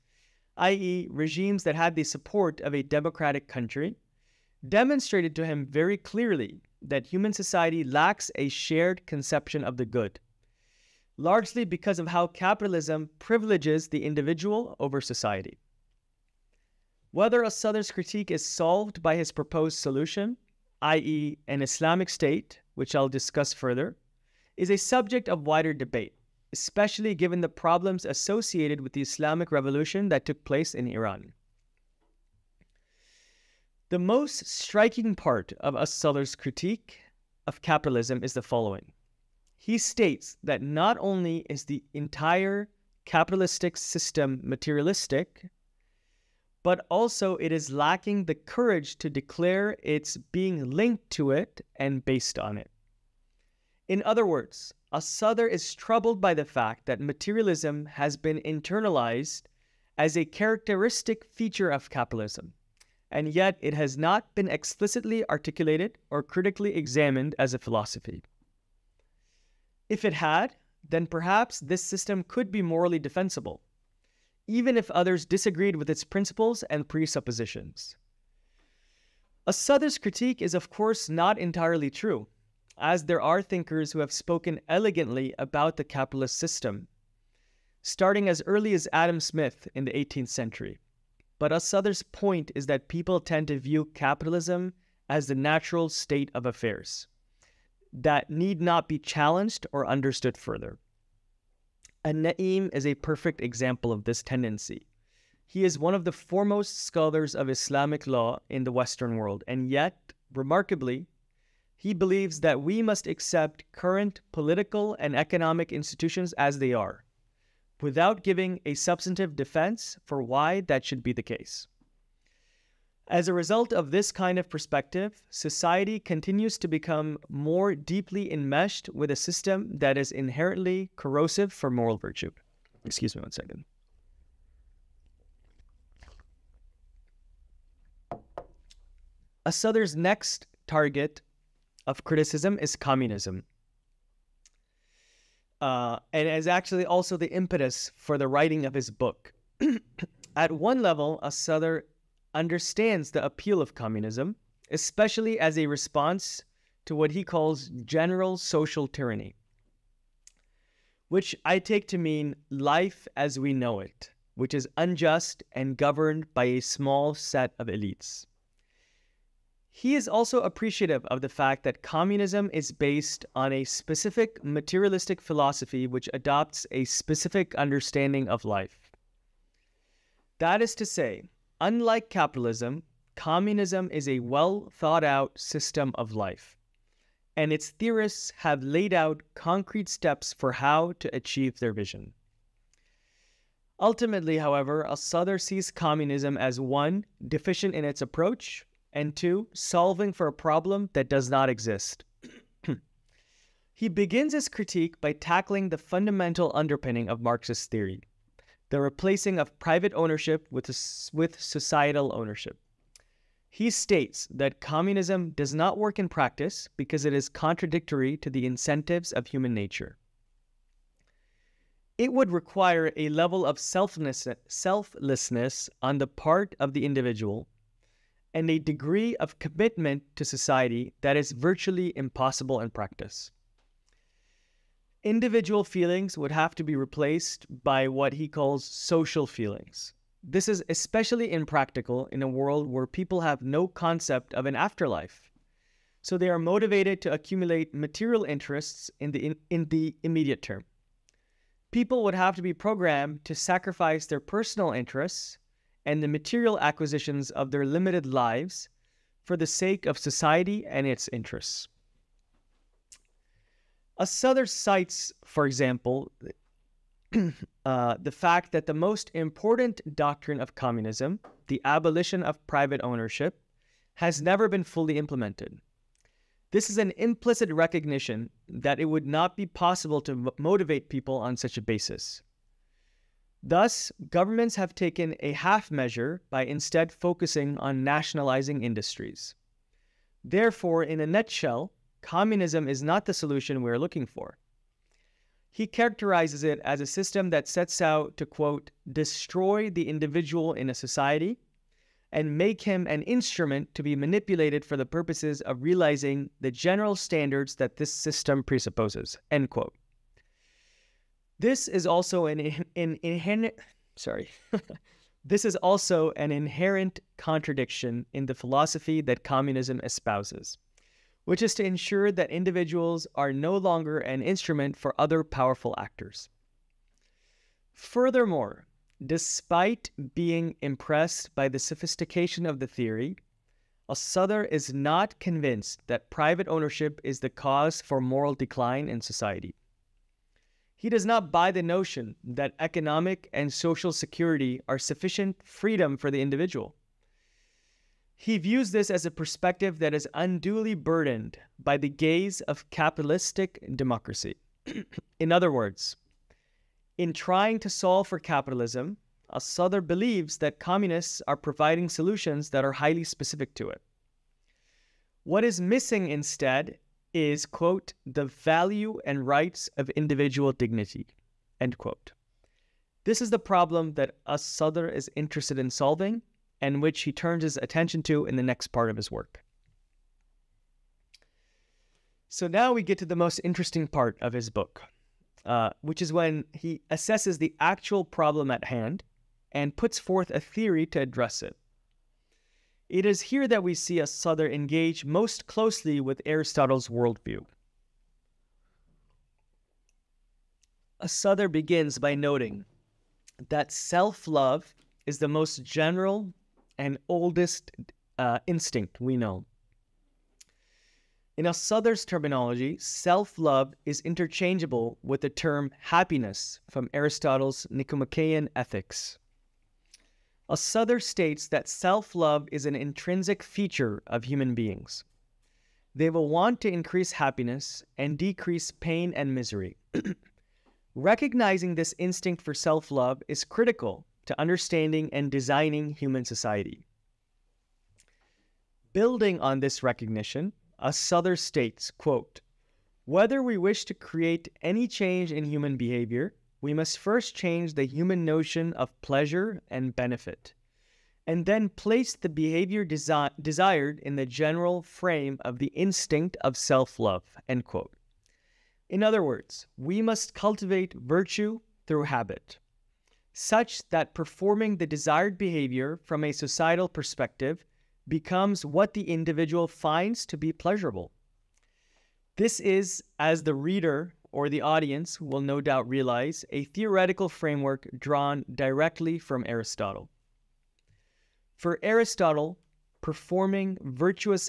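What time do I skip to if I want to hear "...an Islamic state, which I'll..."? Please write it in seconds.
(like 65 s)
21 s.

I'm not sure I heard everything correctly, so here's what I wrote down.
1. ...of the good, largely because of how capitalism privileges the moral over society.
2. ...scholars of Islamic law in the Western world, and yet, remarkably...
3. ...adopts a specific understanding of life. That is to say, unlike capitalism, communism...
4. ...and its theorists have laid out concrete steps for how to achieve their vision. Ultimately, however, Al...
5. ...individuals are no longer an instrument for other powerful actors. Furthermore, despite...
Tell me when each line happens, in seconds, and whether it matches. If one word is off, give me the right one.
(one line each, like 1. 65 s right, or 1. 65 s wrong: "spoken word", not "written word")
1. 9 s wrong: "individual", not "moral"
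2. 106 s right
3. 176 s right
4. 187 s right
5. 322 s right.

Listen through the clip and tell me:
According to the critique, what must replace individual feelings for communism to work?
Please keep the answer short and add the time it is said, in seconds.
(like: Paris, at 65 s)
social feelings, at 238 s.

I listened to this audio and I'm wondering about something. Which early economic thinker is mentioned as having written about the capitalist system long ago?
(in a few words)
Adam Smith.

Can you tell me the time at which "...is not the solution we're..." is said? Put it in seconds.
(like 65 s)
292 s.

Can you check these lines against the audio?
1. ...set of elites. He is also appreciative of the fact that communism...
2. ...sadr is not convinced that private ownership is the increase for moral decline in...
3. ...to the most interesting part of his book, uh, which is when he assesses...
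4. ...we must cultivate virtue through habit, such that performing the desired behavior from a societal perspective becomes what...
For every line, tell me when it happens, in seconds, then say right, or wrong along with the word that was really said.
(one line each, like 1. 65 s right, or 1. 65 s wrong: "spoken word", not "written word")
1. 167 s right
2. 333 s wrong: "cause", not "increase"
3. 382 s right
4. 459 s right.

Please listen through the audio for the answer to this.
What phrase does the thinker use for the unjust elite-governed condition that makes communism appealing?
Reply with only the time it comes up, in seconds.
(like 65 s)
157 s.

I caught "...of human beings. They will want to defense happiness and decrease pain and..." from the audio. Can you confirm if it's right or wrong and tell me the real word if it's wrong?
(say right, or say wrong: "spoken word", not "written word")
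wrong: "increase", not "defense".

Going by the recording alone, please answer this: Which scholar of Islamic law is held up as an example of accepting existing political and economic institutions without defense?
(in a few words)
Na'im.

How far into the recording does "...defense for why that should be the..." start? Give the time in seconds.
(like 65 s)
119 s.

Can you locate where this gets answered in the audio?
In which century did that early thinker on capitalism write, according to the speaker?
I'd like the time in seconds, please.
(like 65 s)
89 s.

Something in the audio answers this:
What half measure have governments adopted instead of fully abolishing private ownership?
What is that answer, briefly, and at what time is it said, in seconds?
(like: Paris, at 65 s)
nationalizing industries, at 287 s.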